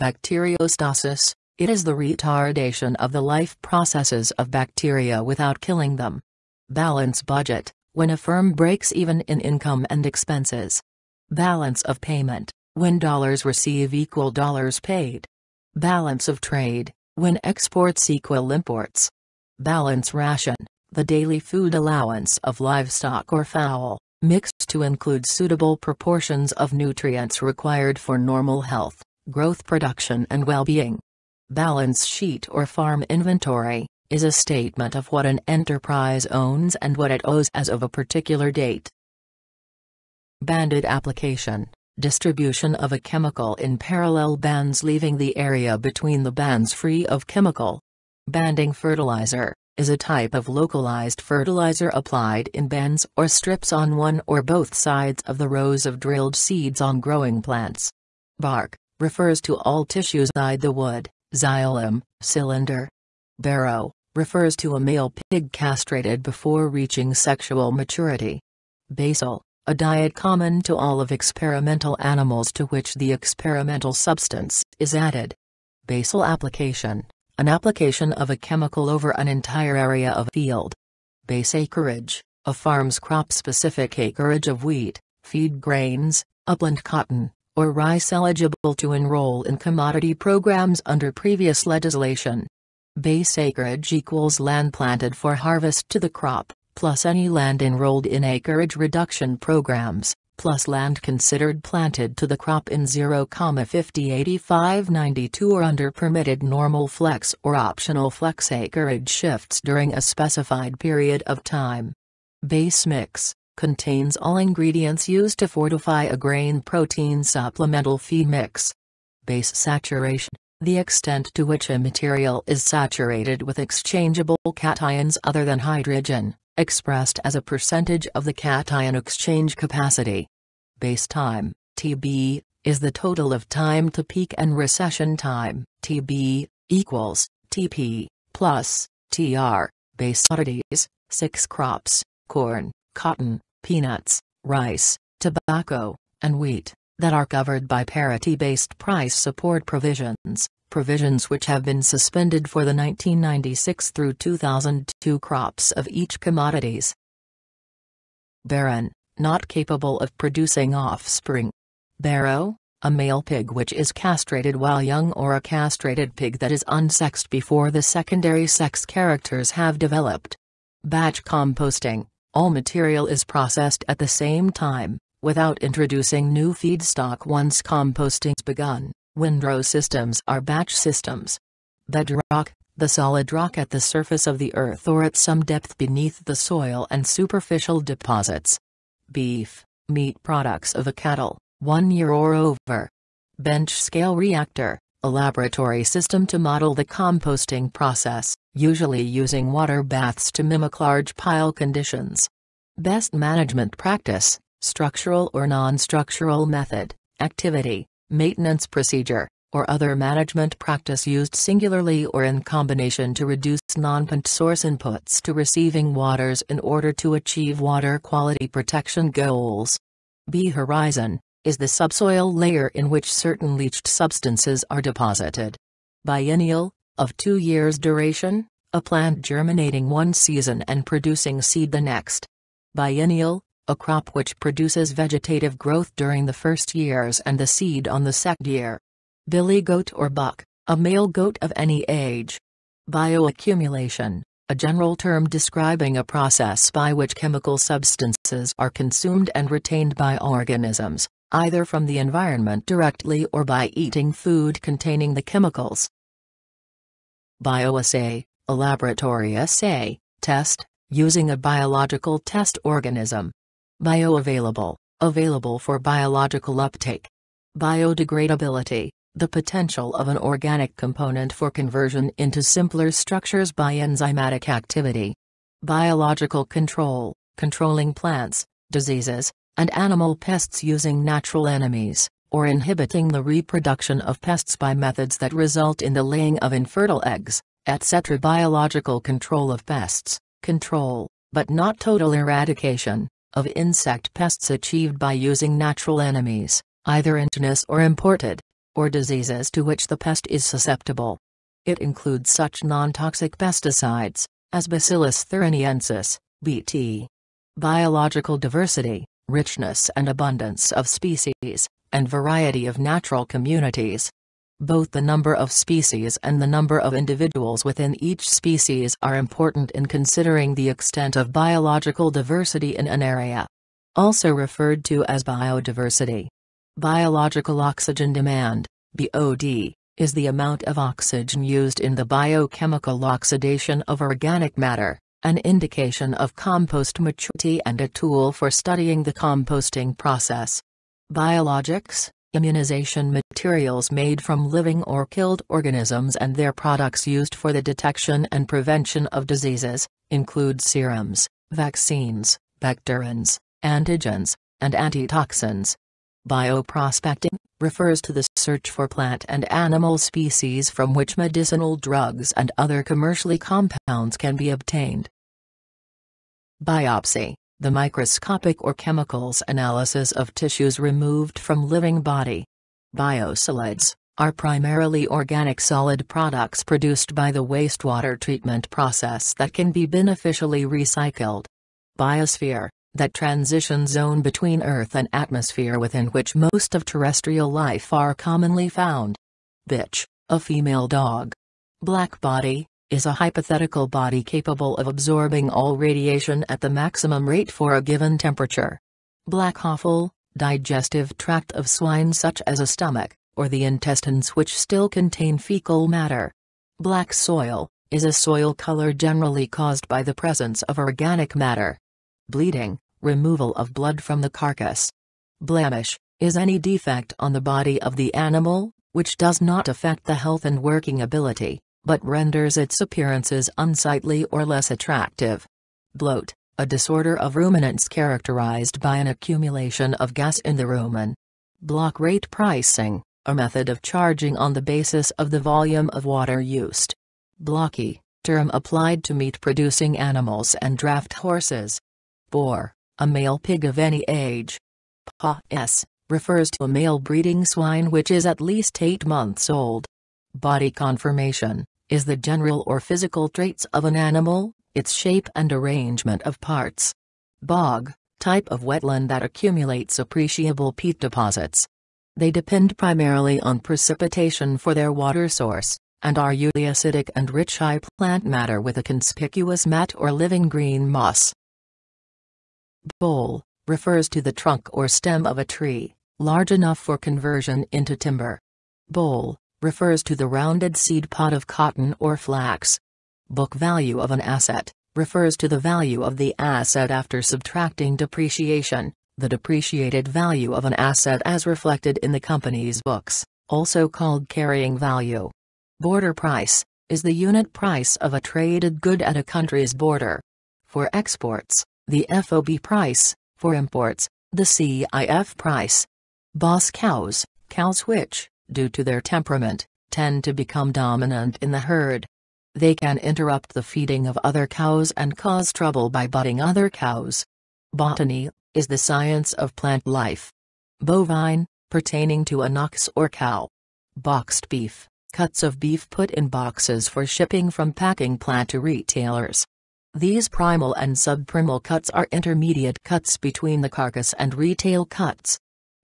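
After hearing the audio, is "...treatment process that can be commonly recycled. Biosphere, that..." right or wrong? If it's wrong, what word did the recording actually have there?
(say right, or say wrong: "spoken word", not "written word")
wrong: "beneficially", not "commonly".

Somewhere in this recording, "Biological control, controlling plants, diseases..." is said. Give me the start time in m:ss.
4:35.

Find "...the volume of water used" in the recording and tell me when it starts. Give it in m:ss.
7:15.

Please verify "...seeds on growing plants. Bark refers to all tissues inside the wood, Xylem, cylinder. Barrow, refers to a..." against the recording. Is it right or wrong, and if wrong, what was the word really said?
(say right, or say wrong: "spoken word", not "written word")
right.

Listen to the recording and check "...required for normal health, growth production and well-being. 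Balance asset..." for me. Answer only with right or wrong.
wrong.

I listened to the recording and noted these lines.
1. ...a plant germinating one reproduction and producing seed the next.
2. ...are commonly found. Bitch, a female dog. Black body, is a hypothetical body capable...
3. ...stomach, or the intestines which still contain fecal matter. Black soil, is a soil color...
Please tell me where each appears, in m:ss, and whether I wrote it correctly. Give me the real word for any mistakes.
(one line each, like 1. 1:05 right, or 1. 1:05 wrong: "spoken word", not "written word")
1. 3:48 wrong: "season", not "reproduction"
2. 6:27 right
3. 6:42 right.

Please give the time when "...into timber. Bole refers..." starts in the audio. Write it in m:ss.
7:57.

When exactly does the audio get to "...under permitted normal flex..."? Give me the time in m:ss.
1:45.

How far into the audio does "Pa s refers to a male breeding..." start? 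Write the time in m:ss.
7:25.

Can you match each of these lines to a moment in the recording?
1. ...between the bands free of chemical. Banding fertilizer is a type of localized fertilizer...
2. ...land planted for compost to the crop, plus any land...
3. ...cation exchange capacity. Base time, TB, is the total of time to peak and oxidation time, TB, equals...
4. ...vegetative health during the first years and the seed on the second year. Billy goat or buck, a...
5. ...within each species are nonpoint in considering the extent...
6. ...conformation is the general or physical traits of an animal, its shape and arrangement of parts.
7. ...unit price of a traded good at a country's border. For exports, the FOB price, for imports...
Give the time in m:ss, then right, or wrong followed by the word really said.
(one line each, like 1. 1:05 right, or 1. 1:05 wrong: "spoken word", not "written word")
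1. 0:45 right
2. 1:34 wrong: "harvest", not "compost"
3. 2:08 wrong: "recession", not "oxidation"
4. 3:54 wrong: "growth", not "health"
5. 5:17 wrong: "important", not "nonpoint"
6. 7:30 right
7. 8:17 right.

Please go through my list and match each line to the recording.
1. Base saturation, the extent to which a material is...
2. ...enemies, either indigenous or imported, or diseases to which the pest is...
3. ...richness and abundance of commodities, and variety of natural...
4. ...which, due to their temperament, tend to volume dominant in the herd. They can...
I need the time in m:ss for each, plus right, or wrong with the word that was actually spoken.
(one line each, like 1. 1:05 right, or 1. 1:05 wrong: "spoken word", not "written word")
1. 1:59 right
2. 4:56 right
3. 5:09 wrong: "species", not "commodities"
4. 8:27 wrong: "become", not "volume".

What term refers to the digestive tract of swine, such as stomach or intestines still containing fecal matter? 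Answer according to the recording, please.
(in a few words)
Black offal.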